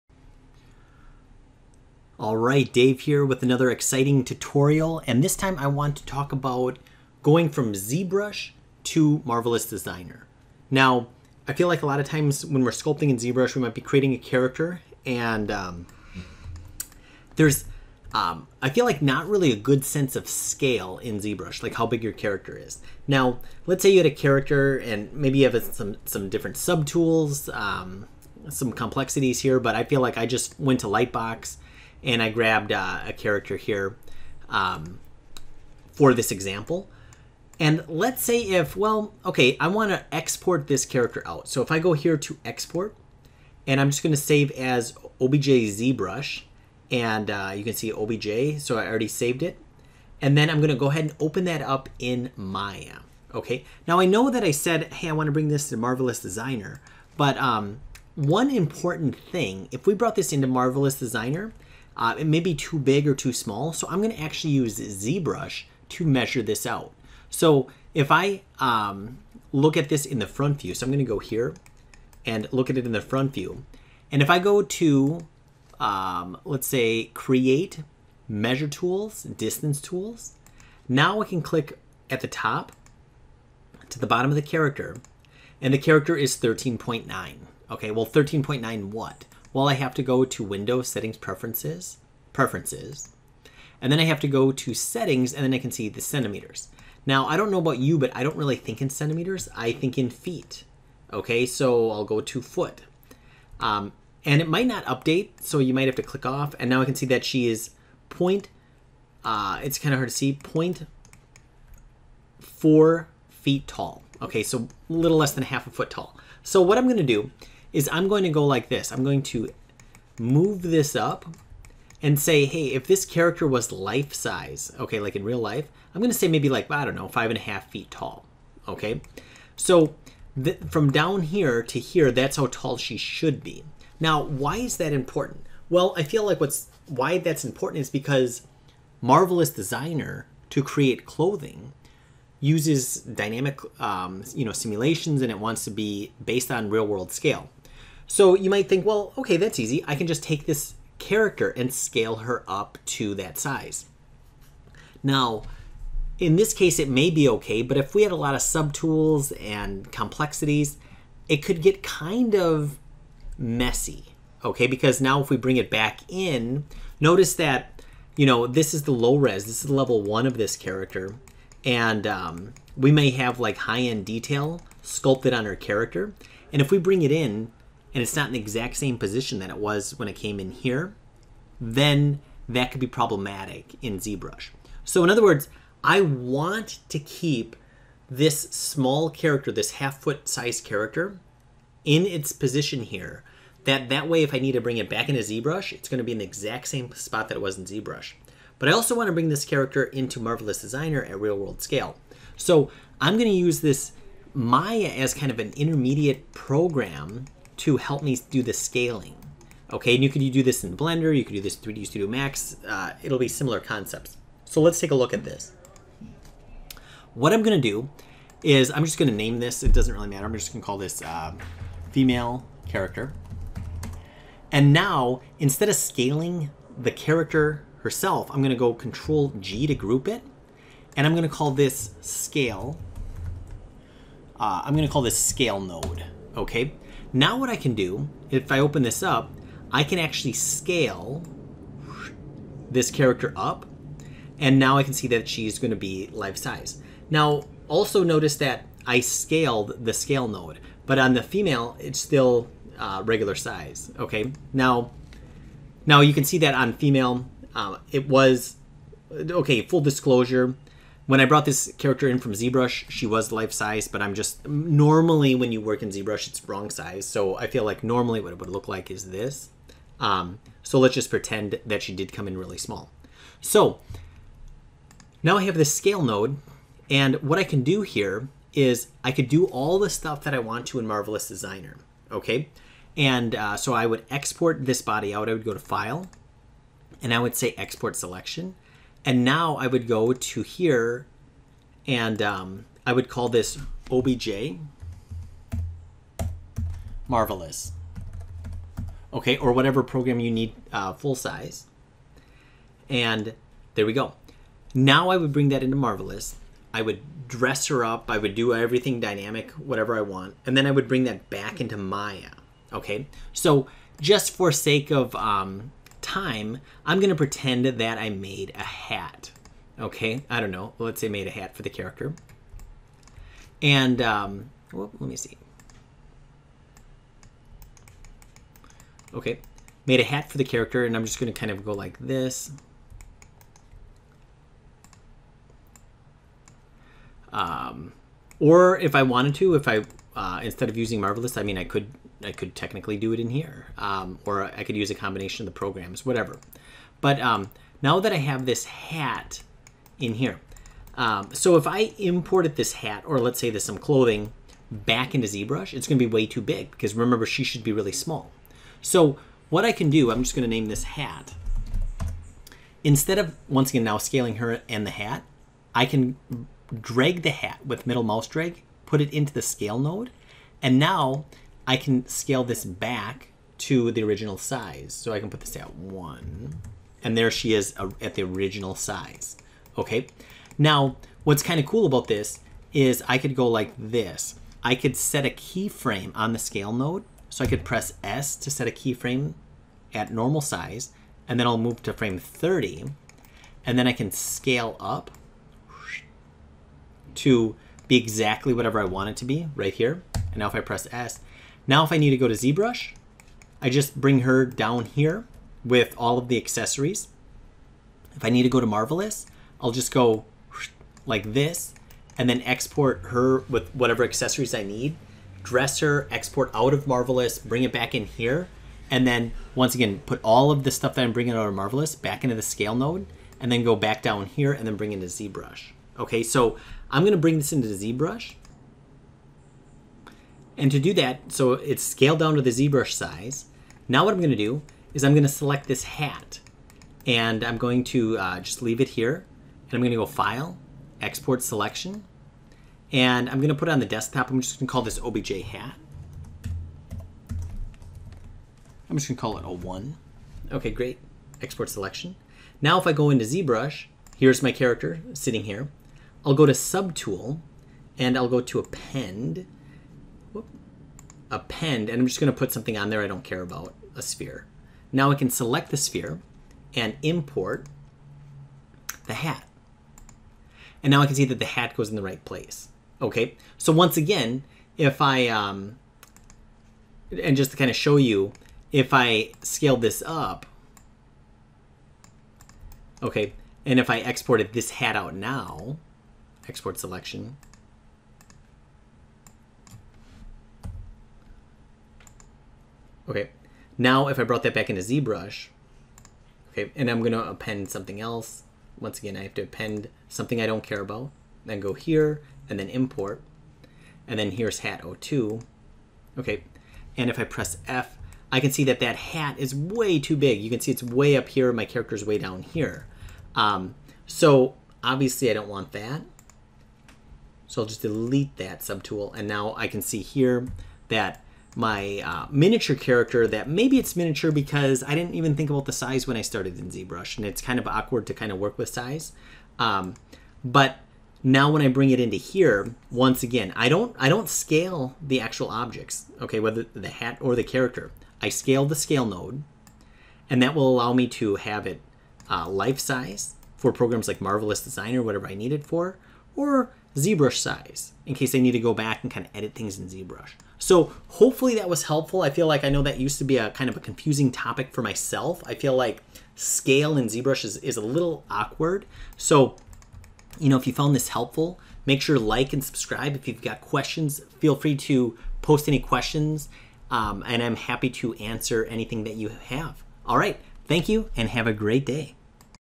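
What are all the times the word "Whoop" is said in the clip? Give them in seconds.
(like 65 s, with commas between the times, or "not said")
460 s.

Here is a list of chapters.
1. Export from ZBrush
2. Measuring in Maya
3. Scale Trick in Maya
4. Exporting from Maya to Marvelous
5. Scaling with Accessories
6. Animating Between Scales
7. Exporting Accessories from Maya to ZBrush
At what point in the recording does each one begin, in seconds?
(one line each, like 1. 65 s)
1. 42 s
2. 67 s
3. 218 s
4. 283 s
5. 367 s
6. 385 s
7. 438 s.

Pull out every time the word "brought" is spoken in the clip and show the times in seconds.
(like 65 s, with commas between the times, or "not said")
59 s, 261 s, 494 s.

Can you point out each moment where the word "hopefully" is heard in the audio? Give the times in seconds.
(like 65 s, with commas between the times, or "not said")
551 s.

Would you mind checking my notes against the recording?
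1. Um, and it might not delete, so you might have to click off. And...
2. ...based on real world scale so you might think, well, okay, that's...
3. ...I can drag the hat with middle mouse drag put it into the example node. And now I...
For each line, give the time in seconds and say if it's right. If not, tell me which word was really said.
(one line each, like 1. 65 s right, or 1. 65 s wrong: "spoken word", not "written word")
1. 103 s wrong: "update", not "delete"
2. 146 s right
3. 365 s wrong: "scale", not "example".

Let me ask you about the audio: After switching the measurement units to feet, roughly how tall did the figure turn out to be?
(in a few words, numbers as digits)
0.4 feet.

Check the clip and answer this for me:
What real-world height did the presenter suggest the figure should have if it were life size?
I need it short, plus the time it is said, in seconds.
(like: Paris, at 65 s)
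5.5 feet, at 127 s.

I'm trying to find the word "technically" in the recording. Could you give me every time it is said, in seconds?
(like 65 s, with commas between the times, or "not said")
342 s.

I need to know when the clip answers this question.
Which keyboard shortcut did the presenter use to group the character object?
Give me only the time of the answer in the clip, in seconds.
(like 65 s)
228 s.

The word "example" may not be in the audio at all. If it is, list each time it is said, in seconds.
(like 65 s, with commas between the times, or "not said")
36 s.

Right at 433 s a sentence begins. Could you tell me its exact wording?
Now what I'm going to do is I'm going to select this hat.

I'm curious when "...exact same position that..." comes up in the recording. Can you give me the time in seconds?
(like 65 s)
178 s.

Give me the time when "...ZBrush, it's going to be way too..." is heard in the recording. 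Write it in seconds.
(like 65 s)
355 s.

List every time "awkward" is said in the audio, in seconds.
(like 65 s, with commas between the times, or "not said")
527 s, 558 s.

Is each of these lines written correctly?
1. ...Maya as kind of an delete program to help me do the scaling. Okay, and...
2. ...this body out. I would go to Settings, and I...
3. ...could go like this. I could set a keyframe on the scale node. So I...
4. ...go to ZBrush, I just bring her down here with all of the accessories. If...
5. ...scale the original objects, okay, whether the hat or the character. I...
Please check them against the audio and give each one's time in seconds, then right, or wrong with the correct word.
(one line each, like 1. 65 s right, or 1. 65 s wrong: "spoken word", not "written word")
1. 204 s wrong: "intermediate", not "delete"
2. 284 s wrong: "File", not "Settings"
3. 383 s right
4. 402 s right
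5. 534 s wrong: "actual", not "original".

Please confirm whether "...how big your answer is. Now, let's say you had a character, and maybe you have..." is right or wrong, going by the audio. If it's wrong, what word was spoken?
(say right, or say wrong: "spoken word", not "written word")
wrong: "character", not "answer".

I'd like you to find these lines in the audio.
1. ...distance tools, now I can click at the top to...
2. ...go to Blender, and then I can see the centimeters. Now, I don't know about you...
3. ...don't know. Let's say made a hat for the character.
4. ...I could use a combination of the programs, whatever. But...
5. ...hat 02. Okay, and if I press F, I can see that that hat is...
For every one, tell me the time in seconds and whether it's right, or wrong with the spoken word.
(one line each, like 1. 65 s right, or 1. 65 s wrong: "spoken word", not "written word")
1. 79 s right
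2. 94 s wrong: "Settings", not "Blender"
3. 320 s right
4. 344 s right
5. 504 s right.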